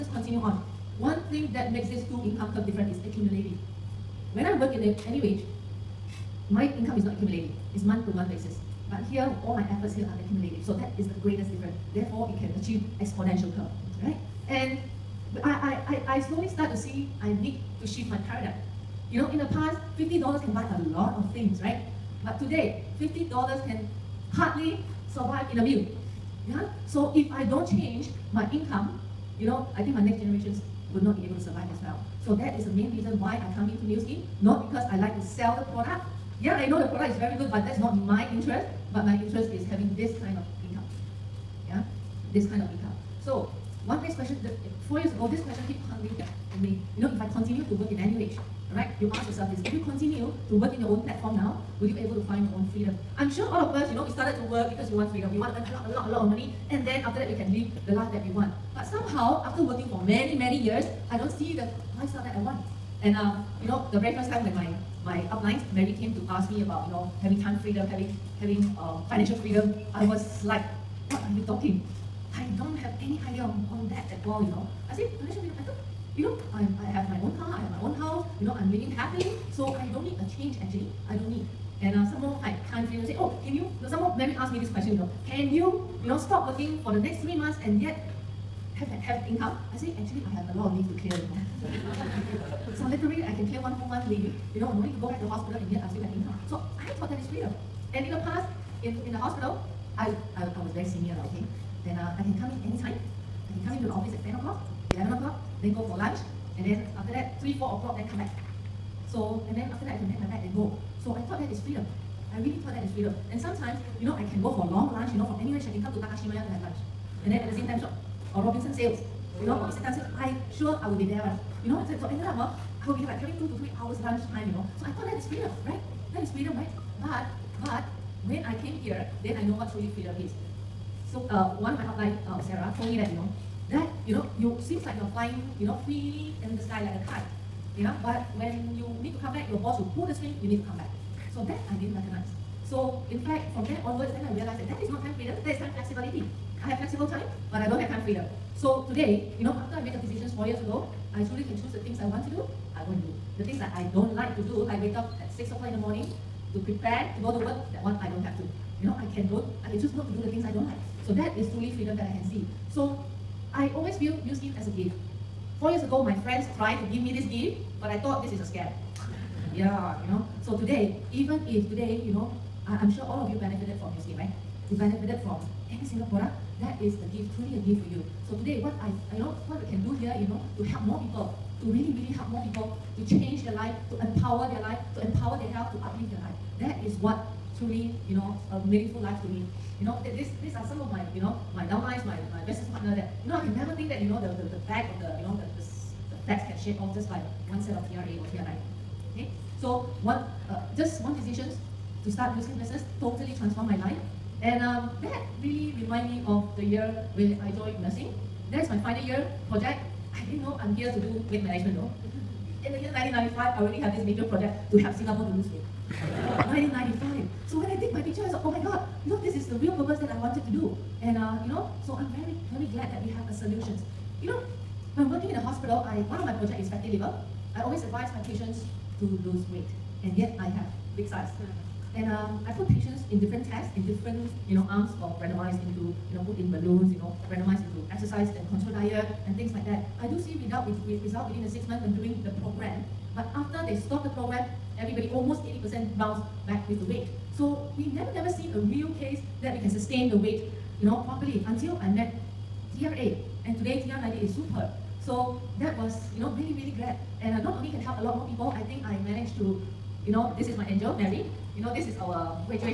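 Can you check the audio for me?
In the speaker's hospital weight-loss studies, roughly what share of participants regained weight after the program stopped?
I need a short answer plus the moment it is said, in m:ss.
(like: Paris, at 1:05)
80%, at 4:05.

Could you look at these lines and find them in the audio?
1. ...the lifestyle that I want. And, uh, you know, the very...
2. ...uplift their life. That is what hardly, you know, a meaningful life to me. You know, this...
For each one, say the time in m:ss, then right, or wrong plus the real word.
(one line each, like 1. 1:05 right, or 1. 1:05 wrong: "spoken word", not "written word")
1. 1:01 right
2. 3:05 wrong: "truly", not "hardly".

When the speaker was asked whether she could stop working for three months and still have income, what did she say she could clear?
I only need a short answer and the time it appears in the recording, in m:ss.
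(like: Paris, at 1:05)
one whole month leave, at 1:33.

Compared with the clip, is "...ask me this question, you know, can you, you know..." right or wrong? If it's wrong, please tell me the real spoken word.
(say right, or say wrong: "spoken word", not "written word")
right.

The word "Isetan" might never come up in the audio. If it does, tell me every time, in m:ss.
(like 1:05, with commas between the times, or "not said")
1:59.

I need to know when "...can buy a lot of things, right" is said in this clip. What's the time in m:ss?
0:20.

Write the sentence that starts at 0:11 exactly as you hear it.
Therefore, it can achieve exponential curve, right?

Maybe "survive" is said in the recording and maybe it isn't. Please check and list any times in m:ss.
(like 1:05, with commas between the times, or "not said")
0:25, 0:31.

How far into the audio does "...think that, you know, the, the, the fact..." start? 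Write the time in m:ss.
3:13.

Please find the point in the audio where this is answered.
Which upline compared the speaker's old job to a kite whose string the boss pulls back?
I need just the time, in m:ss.
2:12.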